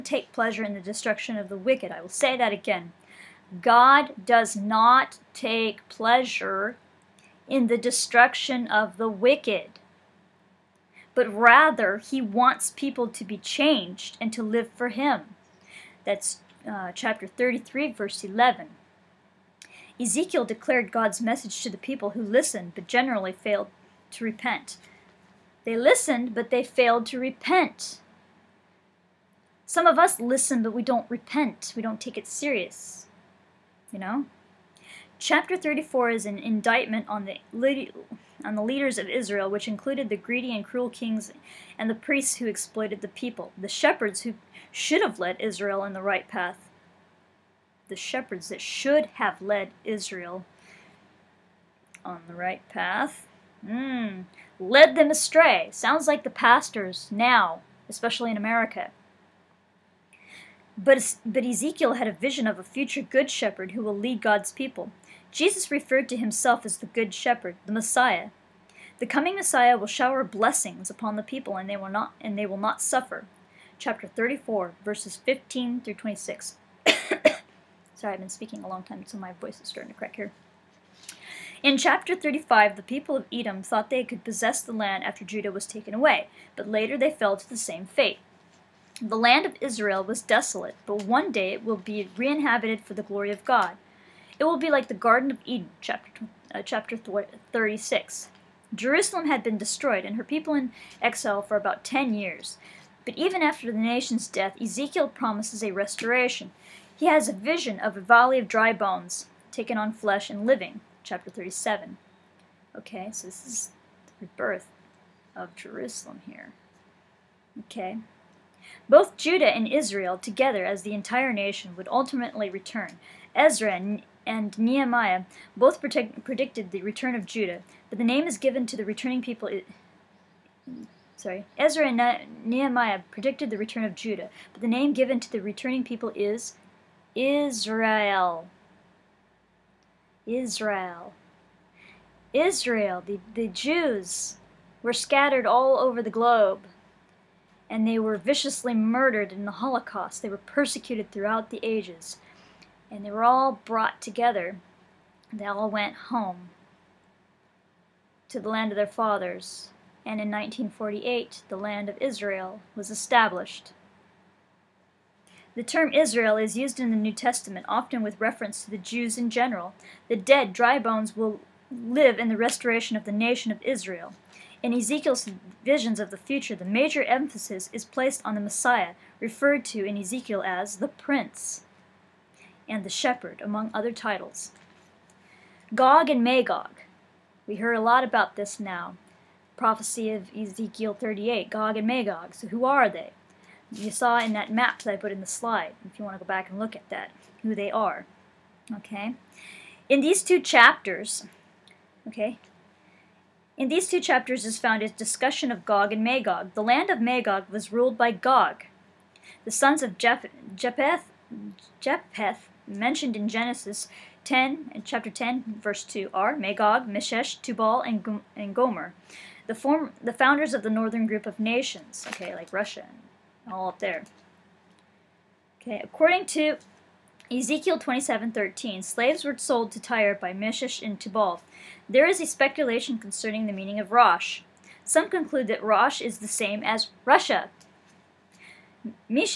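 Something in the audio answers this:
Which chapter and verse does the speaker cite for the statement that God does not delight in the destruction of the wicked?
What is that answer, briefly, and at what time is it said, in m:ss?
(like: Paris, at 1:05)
Chapter 33, verse 11, at 0:16.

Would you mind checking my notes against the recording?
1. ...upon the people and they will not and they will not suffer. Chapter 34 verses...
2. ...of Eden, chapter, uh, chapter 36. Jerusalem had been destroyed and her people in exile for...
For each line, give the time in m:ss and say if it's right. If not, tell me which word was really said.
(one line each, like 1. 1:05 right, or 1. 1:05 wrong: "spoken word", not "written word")
1. 1:10 right
2. 1:35 right.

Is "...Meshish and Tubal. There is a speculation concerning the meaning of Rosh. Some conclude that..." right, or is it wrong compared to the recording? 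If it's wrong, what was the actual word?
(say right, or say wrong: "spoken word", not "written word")
right.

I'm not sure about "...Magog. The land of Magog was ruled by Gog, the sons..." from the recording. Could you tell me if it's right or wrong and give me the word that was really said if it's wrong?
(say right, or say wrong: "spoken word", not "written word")
right.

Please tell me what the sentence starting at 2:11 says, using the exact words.
Sorry, Ezra and Nehemiah predicted the return of Judah, but the name given to the returning people is Israel.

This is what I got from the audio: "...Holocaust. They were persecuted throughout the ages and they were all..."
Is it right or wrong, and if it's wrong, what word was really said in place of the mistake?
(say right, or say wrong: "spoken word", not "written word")
right.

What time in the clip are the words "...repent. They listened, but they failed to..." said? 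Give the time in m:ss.
0:24.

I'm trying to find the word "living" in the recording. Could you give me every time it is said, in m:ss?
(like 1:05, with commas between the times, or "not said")
1:50.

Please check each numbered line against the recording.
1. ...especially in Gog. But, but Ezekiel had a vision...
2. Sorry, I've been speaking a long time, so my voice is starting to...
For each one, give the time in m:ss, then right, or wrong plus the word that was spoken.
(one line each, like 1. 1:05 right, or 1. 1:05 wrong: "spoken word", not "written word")
1. 0:57 wrong: "America", not "Gog"
2. 1:17 right.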